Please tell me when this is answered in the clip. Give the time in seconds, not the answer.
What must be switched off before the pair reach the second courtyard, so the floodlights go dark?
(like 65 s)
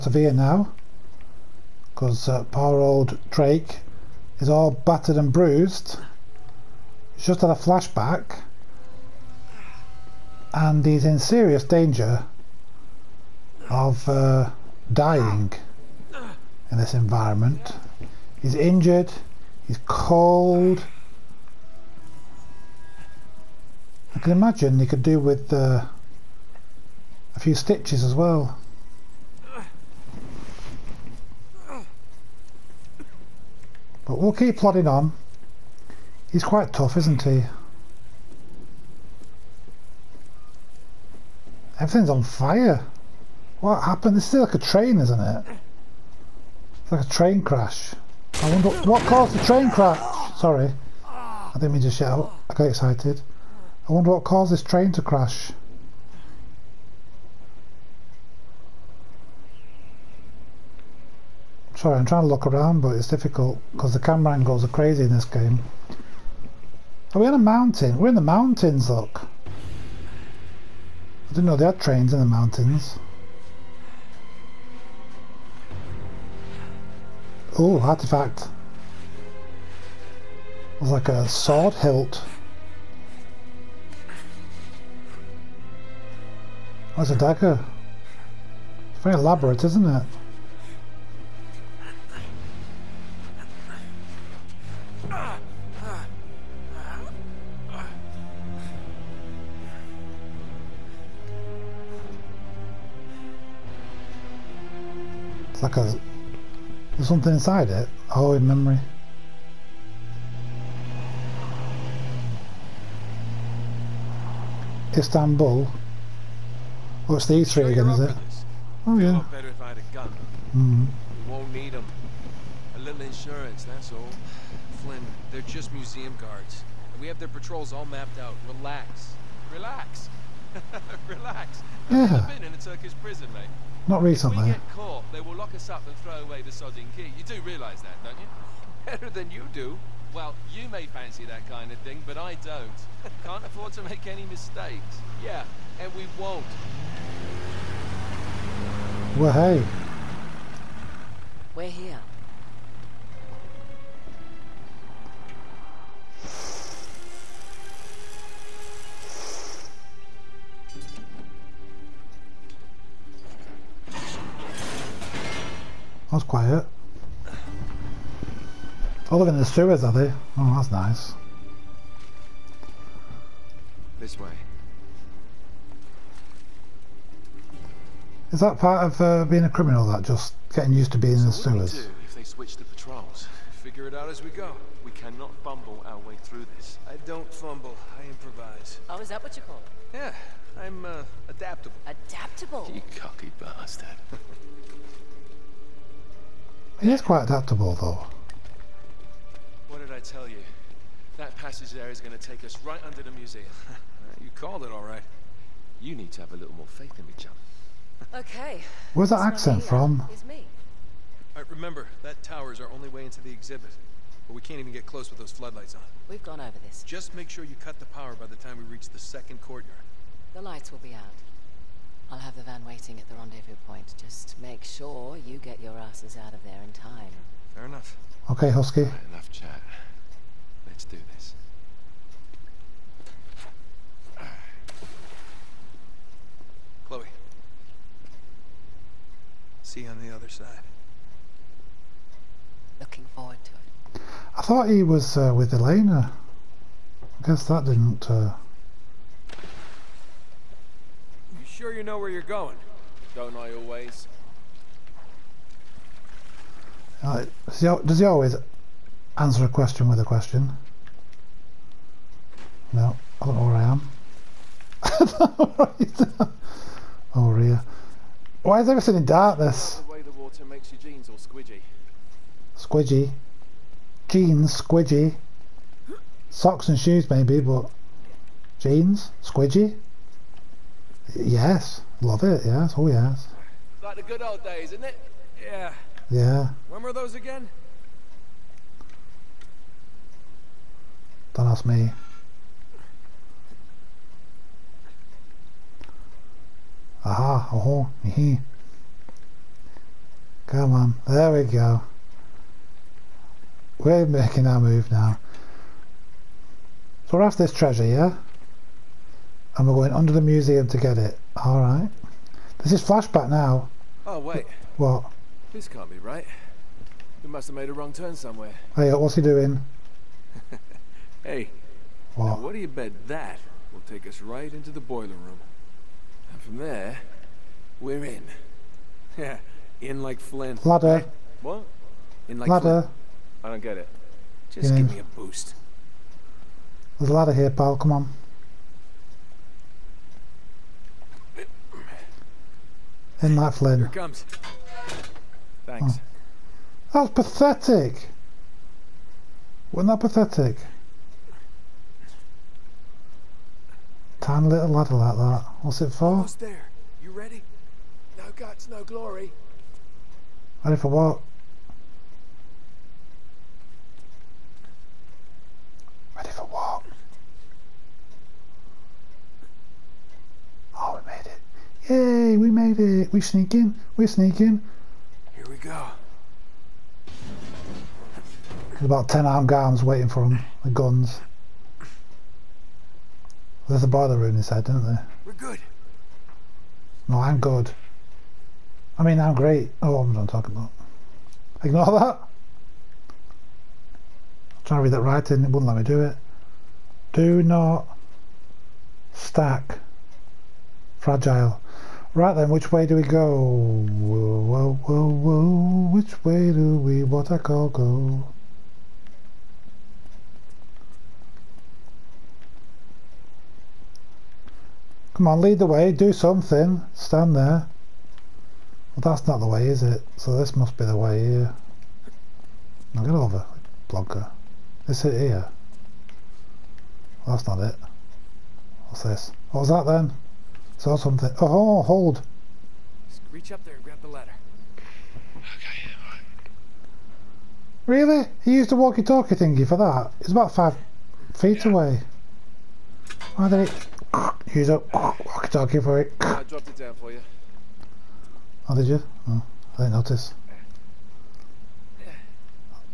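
217 s.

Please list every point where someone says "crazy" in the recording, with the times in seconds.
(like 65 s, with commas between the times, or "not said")
64 s.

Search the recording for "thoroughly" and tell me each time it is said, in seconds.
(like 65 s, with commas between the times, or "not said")
not said.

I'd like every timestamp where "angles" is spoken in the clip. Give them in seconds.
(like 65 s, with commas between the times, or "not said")
64 s.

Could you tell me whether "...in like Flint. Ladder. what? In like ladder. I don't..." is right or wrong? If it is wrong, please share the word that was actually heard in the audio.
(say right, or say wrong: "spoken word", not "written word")
right.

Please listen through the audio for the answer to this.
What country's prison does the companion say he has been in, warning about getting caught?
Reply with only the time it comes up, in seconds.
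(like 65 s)
132 s.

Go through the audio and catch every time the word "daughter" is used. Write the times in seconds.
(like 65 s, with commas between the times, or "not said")
not said.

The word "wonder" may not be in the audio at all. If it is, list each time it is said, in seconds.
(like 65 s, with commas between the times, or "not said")
48 s, 53 s.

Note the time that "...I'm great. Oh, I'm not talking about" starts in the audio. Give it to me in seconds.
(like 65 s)
389 s.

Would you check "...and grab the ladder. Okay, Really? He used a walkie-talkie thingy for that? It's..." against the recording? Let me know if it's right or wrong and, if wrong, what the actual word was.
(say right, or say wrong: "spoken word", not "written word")
right.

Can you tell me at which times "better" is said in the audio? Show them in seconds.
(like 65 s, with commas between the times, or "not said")
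119 s, 138 s.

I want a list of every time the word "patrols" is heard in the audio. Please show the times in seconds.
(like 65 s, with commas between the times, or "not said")
127 s, 182 s.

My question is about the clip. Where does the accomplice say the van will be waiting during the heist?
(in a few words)
the rendezvous point.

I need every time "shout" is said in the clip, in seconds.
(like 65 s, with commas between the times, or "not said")
51 s.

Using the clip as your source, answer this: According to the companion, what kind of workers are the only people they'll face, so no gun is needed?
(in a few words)
museum guards.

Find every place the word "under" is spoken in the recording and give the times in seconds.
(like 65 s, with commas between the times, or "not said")
202 s, 309 s.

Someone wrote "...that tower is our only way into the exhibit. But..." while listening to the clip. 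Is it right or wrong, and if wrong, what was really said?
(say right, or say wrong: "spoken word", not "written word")
right.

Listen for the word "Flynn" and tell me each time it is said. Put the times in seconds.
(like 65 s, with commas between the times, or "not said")
124 s, 343 s.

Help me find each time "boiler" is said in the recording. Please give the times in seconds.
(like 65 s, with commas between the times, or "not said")
324 s, 383 s.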